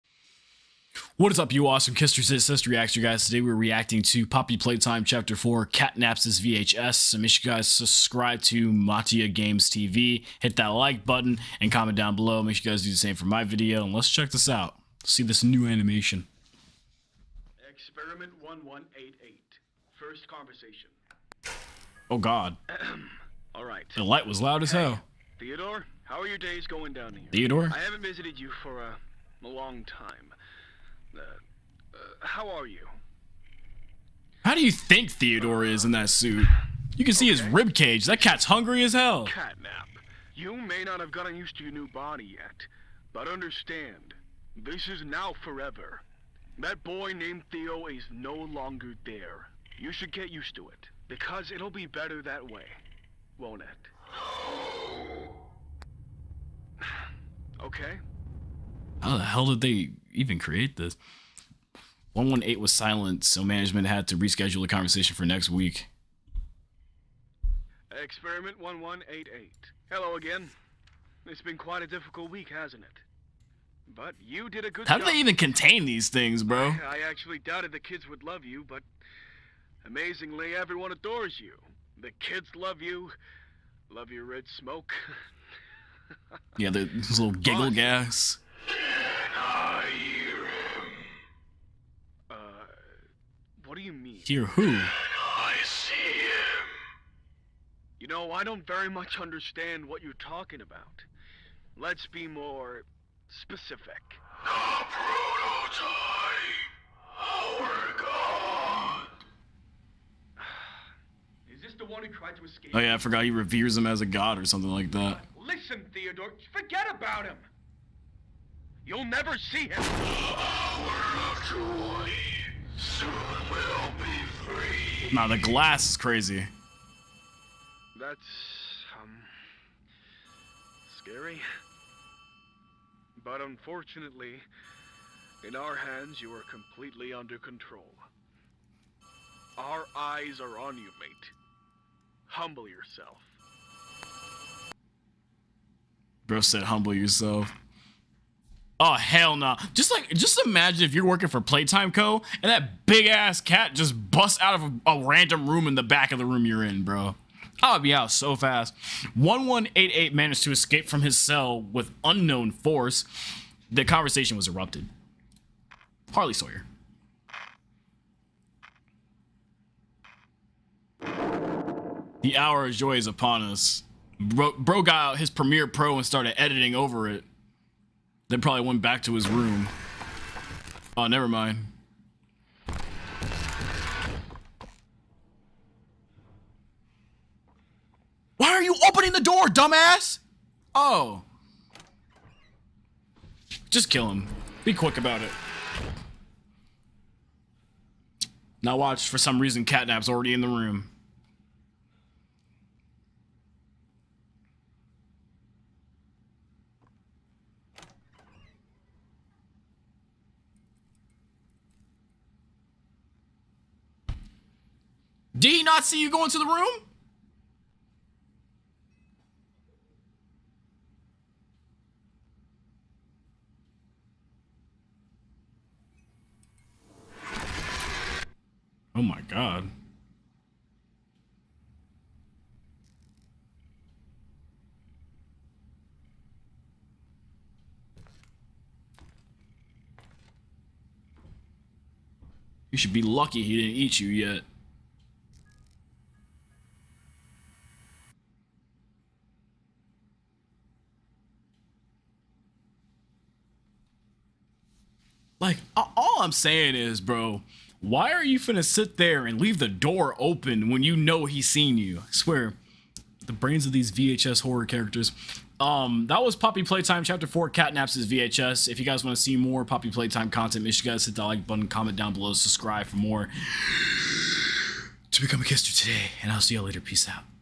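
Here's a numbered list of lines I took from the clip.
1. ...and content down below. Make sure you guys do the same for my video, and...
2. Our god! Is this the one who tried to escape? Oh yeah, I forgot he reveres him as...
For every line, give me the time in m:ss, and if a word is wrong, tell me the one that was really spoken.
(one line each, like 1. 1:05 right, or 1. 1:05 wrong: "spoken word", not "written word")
1. 0:11 wrong: "comment", not "content"
2. 1:47 right.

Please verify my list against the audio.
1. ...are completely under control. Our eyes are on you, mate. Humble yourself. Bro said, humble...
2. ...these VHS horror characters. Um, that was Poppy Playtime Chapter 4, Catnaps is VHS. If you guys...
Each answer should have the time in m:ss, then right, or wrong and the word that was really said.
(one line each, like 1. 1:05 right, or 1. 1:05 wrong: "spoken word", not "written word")
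1. 2:16 right
2. 4:23 right.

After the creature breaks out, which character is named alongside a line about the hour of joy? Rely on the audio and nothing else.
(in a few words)
Harley Sawyer.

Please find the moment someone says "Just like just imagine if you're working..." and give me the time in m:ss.
2:29.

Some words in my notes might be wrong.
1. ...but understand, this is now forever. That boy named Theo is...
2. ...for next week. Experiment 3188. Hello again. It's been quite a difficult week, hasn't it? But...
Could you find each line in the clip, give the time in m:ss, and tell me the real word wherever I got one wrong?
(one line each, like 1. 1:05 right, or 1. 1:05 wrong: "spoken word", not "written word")
1. 0:43 right
2. 1:05 wrong: "1188", not "3188".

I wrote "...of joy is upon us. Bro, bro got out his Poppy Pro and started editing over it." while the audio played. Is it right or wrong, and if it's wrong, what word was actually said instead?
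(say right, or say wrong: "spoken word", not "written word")
wrong: "Premiere", not "Poppy".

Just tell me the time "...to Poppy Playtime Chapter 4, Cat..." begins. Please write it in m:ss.
0:04.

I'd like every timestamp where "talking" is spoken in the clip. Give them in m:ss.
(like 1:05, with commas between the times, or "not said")
1:40.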